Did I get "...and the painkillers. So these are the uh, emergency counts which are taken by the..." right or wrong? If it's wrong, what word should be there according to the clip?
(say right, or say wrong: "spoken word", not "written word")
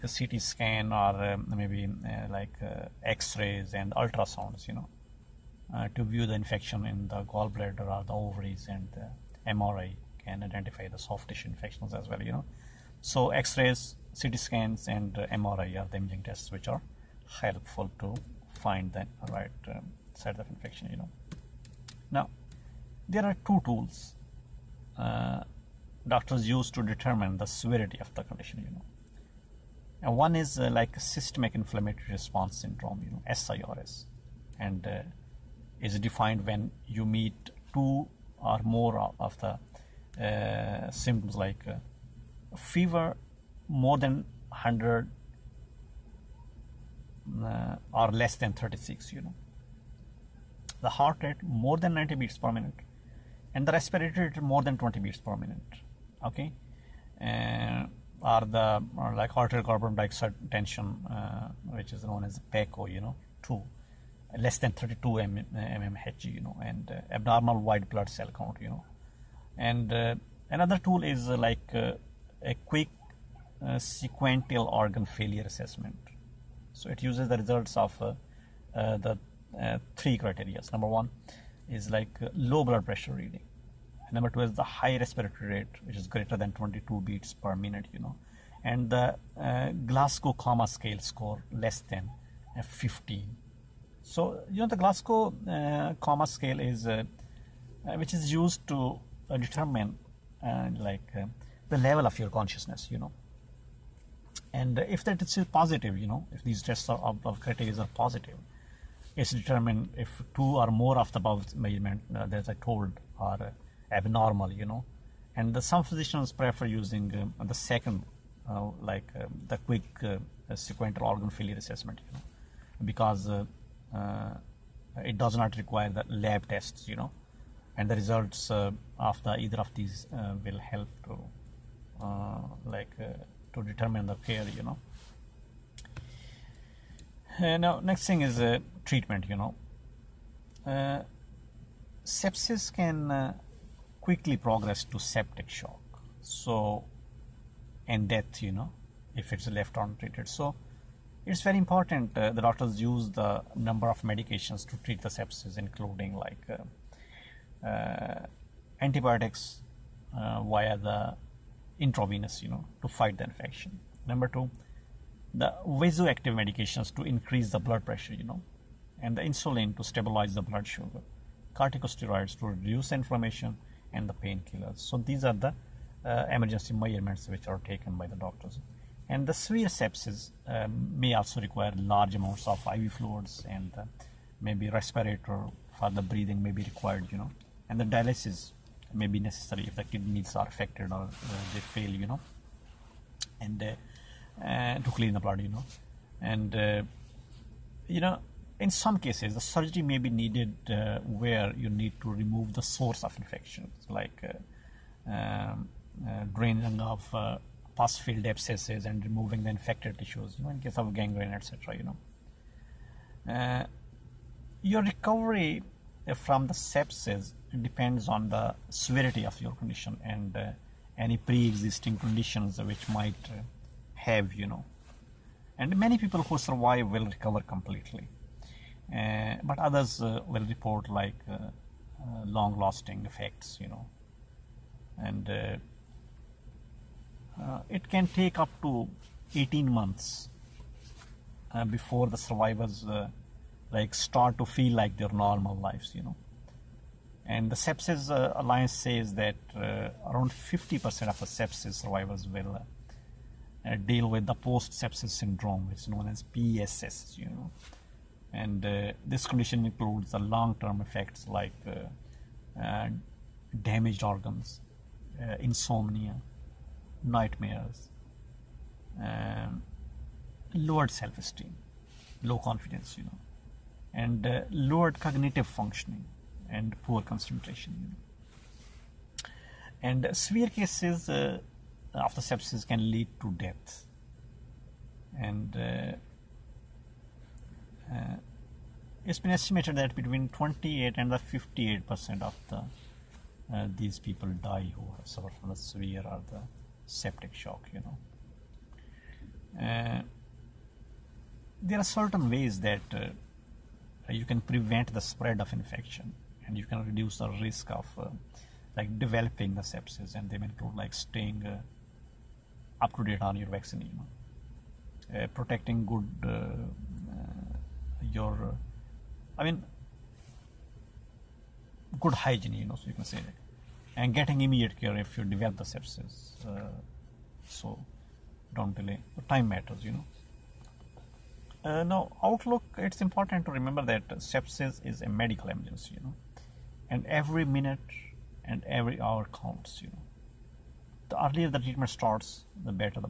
wrong: "measurements", not "counts".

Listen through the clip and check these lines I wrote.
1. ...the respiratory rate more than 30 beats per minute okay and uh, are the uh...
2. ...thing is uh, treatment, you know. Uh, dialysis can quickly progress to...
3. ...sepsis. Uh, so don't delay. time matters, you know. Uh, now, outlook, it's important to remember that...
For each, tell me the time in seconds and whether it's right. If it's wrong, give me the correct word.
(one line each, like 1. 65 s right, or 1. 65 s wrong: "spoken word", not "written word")
1. 53 s wrong: "20", not "30"
2. 138 s wrong: "sepsis", not "dialysis"
3. 325 s right.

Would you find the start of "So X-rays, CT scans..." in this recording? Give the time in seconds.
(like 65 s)
13 s.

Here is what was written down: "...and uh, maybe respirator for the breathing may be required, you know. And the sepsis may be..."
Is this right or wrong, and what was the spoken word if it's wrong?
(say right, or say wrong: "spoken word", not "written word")
wrong: "dialysis", not "sepsis".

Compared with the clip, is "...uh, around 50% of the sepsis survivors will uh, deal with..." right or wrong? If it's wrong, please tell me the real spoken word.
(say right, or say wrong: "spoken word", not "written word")
right.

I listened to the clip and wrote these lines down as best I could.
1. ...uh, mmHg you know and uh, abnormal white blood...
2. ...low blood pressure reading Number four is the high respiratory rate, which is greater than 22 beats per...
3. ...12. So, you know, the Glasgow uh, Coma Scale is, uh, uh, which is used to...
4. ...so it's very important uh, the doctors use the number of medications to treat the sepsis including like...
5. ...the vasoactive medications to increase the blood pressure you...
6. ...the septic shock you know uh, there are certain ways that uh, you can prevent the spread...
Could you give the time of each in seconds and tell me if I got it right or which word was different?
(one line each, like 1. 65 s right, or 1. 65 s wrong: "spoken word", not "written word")
1. 65 s right
2. 82 s wrong: "two", not "four"
3. 92 s wrong: "15", not "12"
4. 150 s right
5. 165 s right
6. 296 s right.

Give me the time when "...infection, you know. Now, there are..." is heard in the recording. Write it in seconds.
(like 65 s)
20 s.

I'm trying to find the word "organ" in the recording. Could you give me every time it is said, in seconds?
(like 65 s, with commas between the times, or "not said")
74 s, 121 s, 264 s.